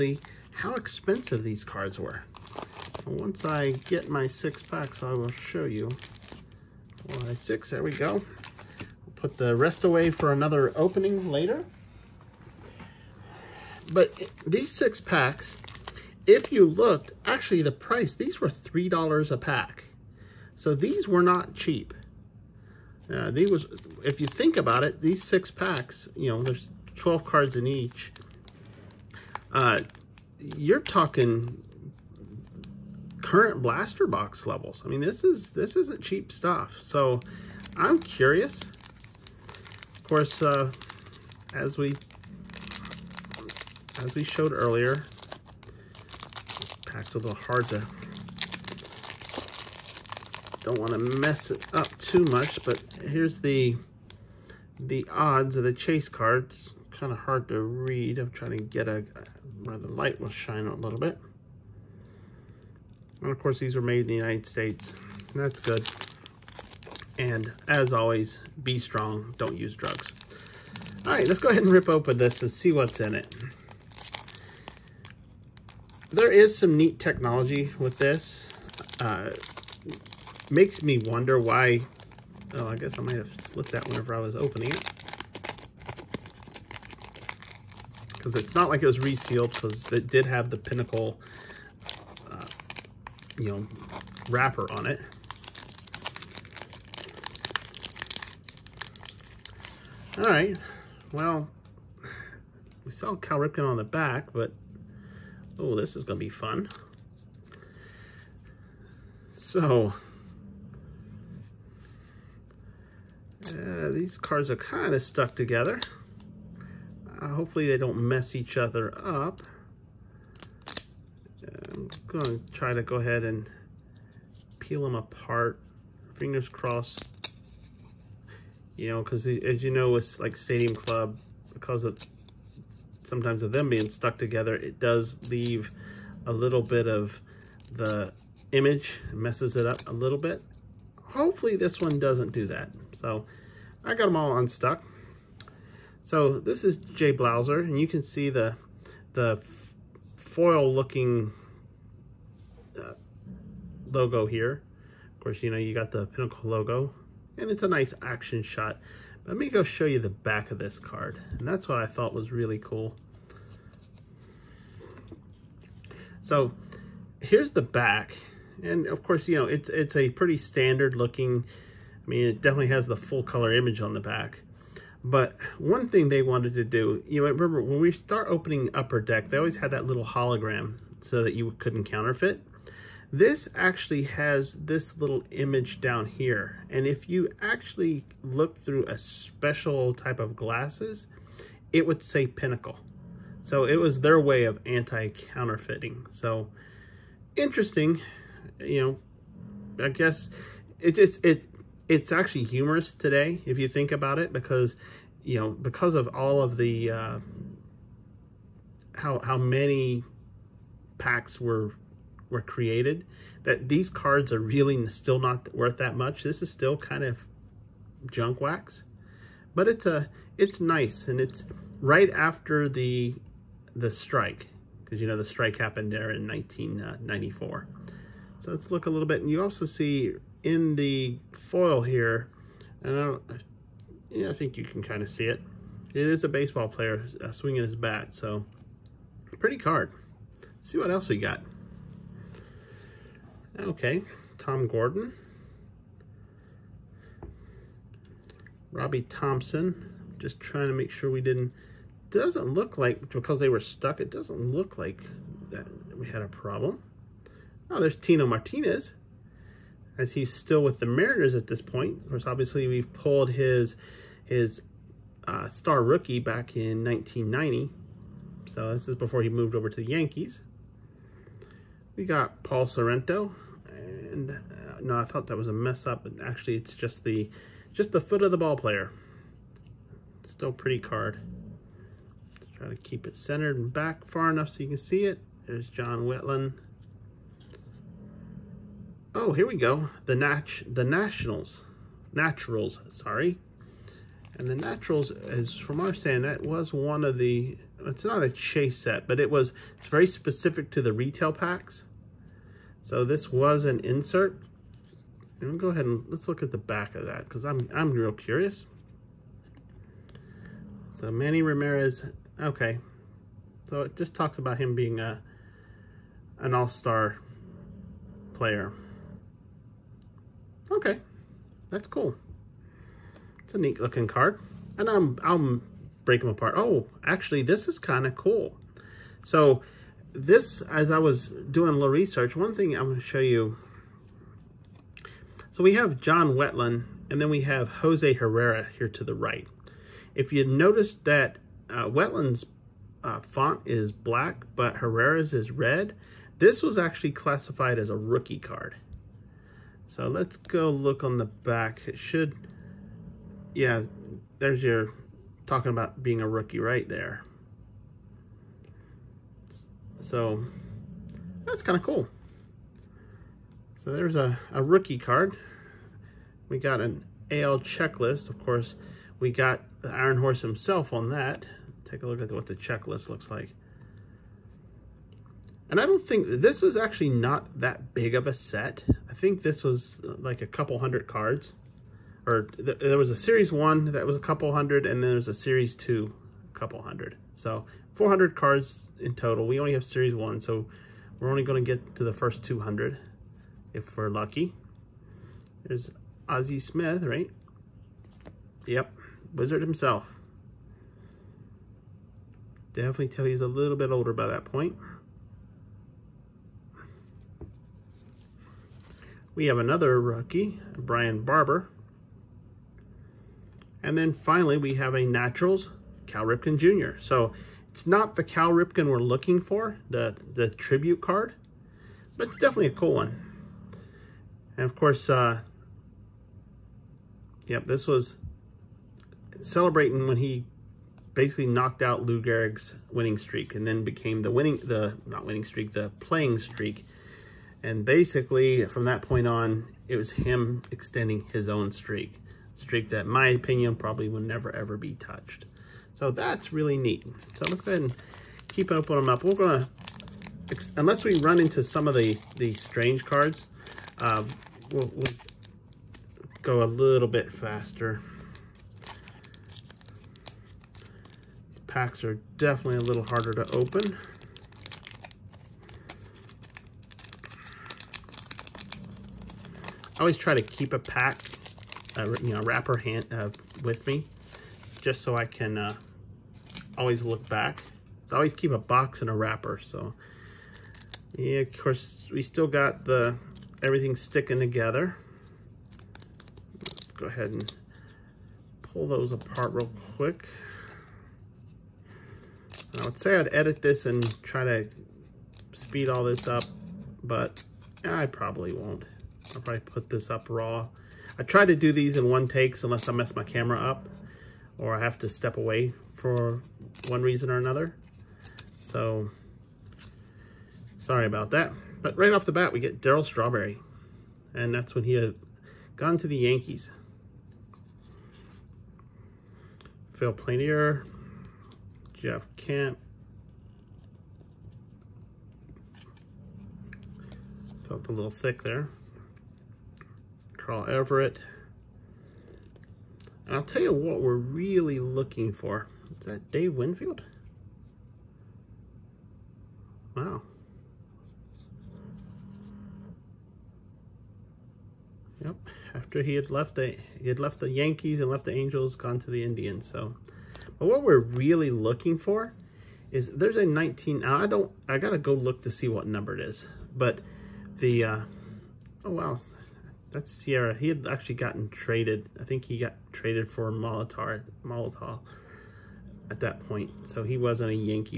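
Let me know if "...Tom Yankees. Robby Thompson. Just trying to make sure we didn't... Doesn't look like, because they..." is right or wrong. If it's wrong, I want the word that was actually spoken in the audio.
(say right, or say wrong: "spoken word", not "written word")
wrong: "Gordon", not "Yankees".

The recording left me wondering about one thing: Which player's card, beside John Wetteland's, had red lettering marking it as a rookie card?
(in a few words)
Jose Herrera.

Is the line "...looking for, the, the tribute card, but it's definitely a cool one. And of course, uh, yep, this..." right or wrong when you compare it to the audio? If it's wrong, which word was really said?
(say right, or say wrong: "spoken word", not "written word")
right.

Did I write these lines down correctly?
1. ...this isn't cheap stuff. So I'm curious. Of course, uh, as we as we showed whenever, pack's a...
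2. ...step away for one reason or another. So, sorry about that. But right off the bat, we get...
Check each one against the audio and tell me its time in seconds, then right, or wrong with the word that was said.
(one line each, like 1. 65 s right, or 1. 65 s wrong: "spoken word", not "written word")
1. 35 s wrong: "earlier", not "whenever"
2. 505 s right.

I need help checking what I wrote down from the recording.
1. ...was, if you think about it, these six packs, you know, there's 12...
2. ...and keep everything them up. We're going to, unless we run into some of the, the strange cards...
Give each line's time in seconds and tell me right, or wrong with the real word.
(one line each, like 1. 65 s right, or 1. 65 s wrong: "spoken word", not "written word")
1. 23 s right
2. 447 s wrong: "opening", not "everything".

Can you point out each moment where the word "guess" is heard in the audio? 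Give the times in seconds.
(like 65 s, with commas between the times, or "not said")
82 s, 199 s.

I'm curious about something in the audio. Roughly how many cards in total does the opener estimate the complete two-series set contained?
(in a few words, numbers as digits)
400.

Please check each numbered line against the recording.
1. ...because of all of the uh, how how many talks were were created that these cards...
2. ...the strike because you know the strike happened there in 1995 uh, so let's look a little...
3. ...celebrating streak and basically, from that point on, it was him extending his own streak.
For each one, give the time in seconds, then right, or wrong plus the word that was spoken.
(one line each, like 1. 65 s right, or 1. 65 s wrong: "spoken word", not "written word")
1. 205 s wrong: "packs", not "talks"
2. 223 s wrong: "1994", not "1995"
3. 435 s wrong: "playing", not "celebrating".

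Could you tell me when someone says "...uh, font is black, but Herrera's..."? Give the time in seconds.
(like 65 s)
343 s.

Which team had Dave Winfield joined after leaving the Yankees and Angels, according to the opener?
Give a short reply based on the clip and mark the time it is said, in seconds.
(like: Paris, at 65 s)
Indians, at 549 s.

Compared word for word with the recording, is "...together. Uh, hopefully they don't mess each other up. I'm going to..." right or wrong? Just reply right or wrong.
right.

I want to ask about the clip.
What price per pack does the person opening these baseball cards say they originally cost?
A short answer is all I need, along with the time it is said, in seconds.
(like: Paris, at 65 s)
$3, at 18 s.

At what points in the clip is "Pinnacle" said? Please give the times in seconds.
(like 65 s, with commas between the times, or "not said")
90 s, 156 s, 192 s.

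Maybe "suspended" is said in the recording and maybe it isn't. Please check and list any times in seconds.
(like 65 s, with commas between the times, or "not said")
not said.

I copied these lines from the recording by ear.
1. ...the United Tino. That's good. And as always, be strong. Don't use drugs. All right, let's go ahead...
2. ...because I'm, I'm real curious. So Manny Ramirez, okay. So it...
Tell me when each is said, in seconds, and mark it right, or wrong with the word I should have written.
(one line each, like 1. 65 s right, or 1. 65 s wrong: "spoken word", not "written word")
1. 64 s wrong: "States", not "Tino"
2. 307 s right.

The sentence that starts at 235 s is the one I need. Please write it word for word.
It is a baseball player uh, swinging his bat, so pretty card.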